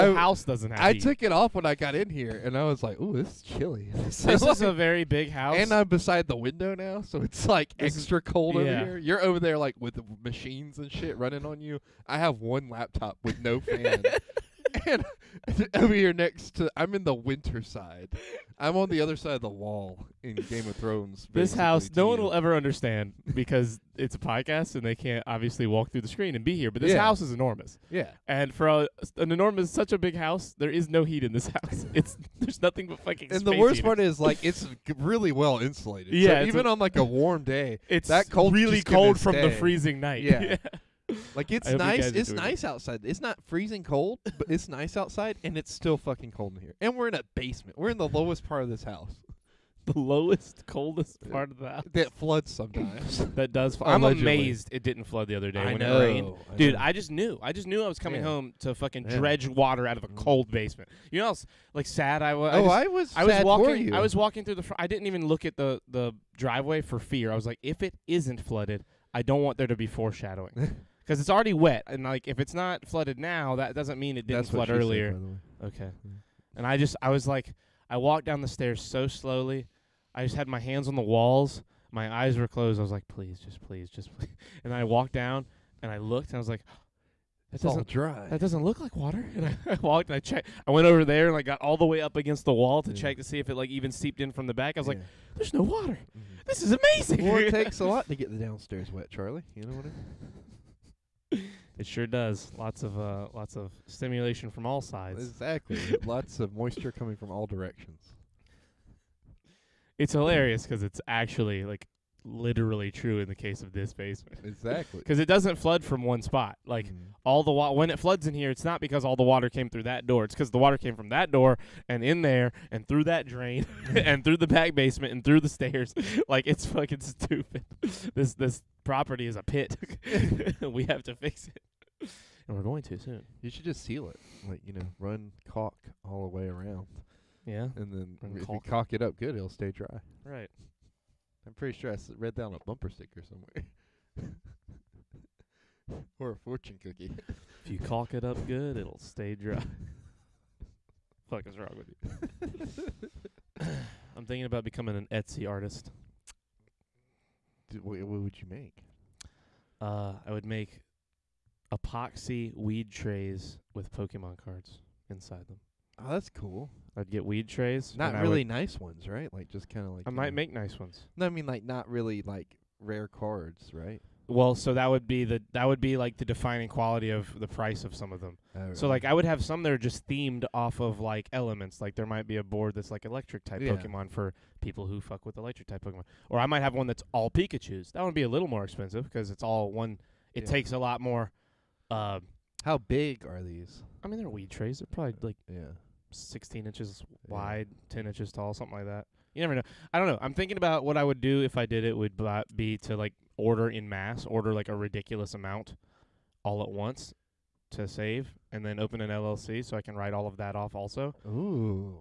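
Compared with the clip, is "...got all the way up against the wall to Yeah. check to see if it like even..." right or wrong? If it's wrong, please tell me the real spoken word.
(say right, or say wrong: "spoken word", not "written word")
right.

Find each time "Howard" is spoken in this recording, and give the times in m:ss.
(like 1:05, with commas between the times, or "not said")
not said.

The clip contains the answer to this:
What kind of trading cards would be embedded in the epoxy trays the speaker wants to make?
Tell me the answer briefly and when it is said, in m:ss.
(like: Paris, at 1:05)
Pokemon cards, at 2:43.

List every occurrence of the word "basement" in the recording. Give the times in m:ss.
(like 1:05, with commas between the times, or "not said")
0:47, 1:00, 1:53, 2:04.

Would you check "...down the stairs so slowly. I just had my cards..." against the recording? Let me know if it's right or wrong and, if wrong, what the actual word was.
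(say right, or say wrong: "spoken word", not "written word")
wrong: "hands", not "cards".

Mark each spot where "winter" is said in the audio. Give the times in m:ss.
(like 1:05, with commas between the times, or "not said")
0:17.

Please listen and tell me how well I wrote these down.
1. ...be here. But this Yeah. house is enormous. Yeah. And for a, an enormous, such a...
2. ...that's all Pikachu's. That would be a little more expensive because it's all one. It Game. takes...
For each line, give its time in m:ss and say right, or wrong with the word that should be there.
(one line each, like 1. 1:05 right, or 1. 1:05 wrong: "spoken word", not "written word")
1. 0:26 right
2. 3:06 wrong: "Yeah", not "Game".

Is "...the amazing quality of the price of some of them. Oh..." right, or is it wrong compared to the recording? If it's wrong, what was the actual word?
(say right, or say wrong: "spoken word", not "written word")
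wrong: "defining", not "amazing".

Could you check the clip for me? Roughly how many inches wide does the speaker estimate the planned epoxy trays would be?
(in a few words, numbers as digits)
16.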